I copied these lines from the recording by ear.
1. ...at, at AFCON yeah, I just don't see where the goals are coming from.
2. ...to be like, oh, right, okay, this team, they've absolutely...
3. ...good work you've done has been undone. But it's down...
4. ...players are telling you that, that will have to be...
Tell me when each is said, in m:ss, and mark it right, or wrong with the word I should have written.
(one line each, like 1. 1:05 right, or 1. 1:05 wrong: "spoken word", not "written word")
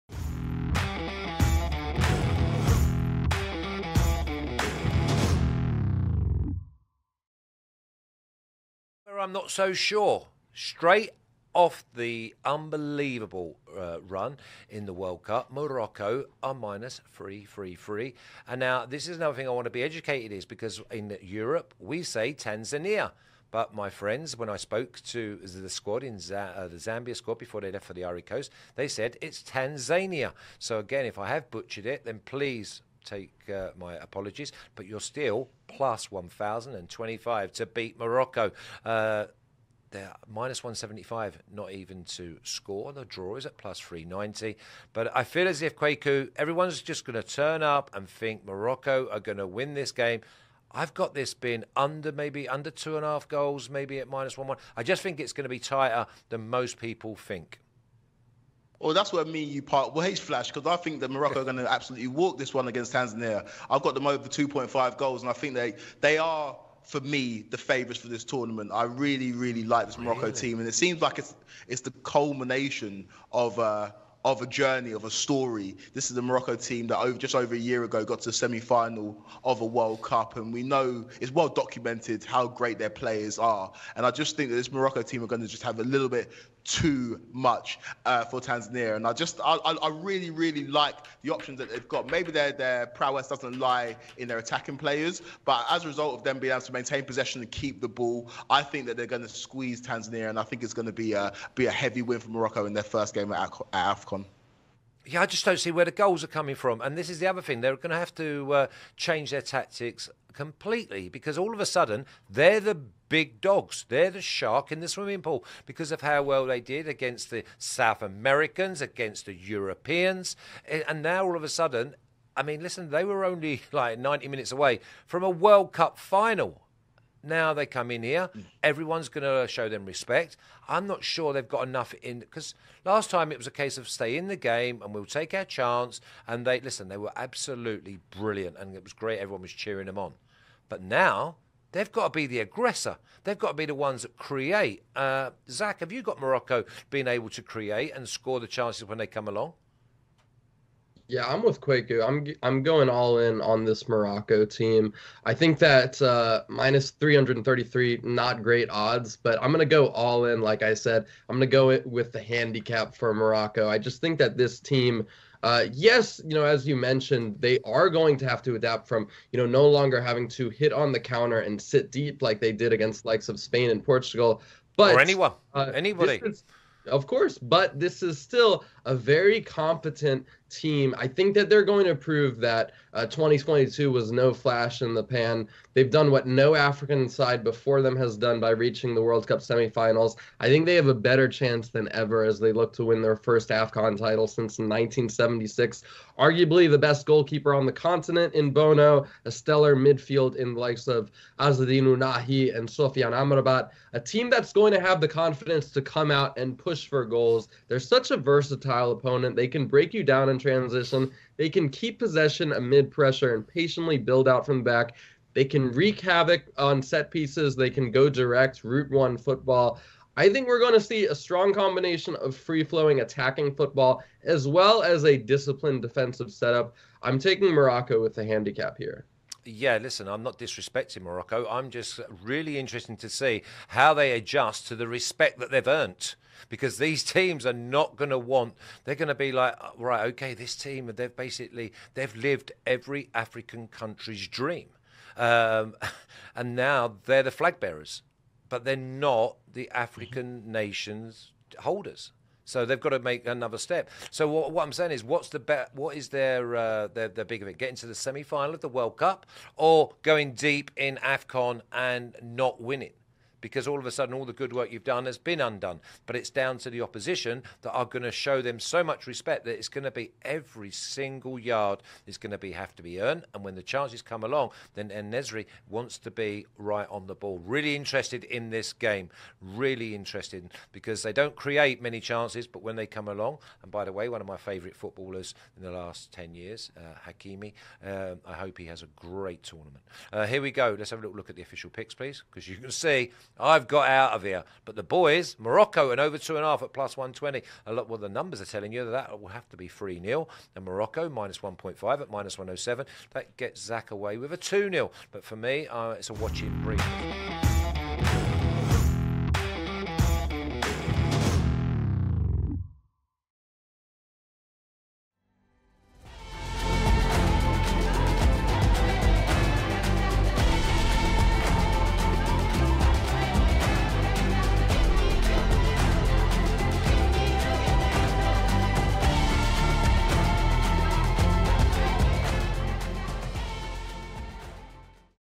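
1. 1:43 right
2. 3:59 wrong: "basically", not "absolutely"
3. 4:24 right
4. 4:58 wrong: "numbers", not "players".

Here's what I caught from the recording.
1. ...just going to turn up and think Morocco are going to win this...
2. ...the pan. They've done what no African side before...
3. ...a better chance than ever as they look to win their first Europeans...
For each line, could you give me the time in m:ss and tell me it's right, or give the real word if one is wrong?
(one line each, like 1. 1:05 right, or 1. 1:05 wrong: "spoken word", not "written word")
1. 0:46 right
2. 3:04 right
3. 3:10 wrong: "AFCON", not "Europeans".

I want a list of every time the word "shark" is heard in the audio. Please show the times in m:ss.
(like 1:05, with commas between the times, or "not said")
1:54.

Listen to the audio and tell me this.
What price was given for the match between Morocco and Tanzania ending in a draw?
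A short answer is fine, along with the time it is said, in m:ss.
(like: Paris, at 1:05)
+390, at 0:43.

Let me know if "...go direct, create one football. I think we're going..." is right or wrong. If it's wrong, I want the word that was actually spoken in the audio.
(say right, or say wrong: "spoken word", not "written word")
wrong: "route", not "create".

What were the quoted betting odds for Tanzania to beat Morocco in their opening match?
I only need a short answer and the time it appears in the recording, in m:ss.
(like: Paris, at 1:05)
+1025, at 0:35.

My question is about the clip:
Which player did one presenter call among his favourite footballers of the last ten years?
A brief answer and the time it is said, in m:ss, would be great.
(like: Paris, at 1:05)
Hakimi, at 4:47.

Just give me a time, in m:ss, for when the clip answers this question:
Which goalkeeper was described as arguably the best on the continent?
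3:18.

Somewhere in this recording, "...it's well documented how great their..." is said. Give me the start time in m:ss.
1:21.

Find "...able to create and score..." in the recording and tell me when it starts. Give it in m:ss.
2:27.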